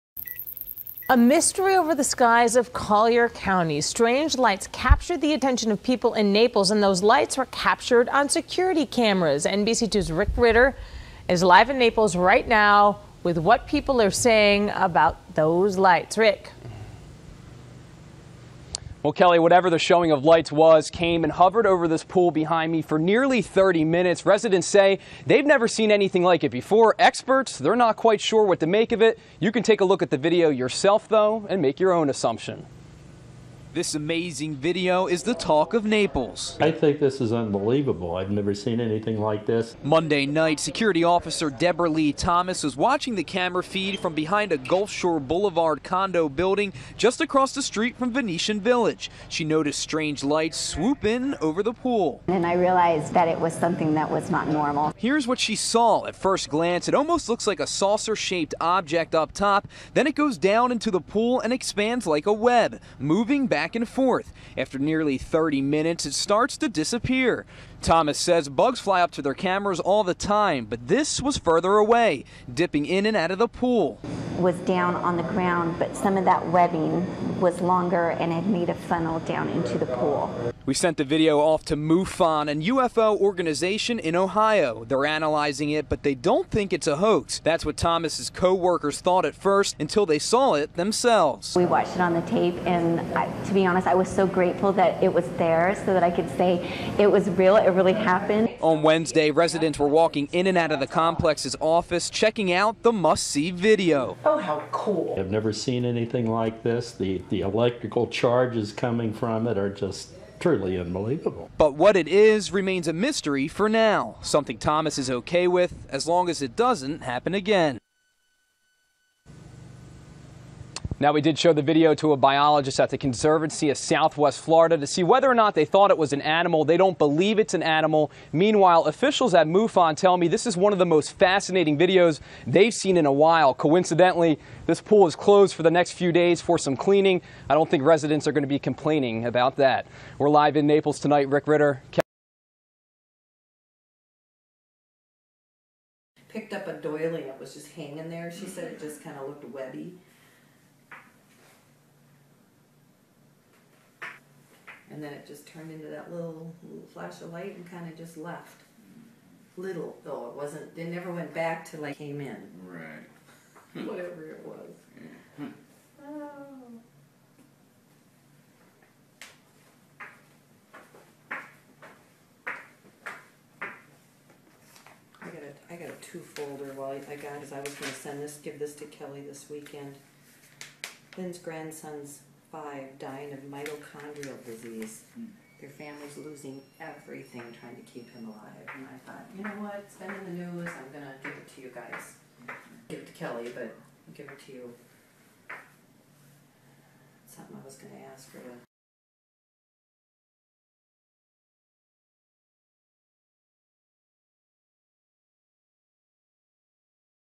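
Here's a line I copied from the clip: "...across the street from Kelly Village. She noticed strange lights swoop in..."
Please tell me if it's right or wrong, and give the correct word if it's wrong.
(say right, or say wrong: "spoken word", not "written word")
wrong: "Venetian", not "Kelly".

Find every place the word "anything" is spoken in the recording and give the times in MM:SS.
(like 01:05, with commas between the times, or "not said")
00:25, 00:38, 01:45.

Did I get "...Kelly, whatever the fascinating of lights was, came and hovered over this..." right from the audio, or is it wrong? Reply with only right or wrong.
wrong.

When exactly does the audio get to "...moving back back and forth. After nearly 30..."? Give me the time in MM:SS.
01:02.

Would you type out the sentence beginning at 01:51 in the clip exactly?
But what it is remains a mystery for now, something Thomas is okay with as long as it doesn't happen again.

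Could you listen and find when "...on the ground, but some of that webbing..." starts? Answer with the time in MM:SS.
01:14.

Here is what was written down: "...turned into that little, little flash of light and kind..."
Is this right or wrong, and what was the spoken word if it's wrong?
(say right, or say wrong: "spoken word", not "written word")
right.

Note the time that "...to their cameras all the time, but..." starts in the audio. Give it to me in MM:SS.
01:09.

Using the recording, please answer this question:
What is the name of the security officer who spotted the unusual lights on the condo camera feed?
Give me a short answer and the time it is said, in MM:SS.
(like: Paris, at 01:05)
Deborah Lee Thomas, at 00:41.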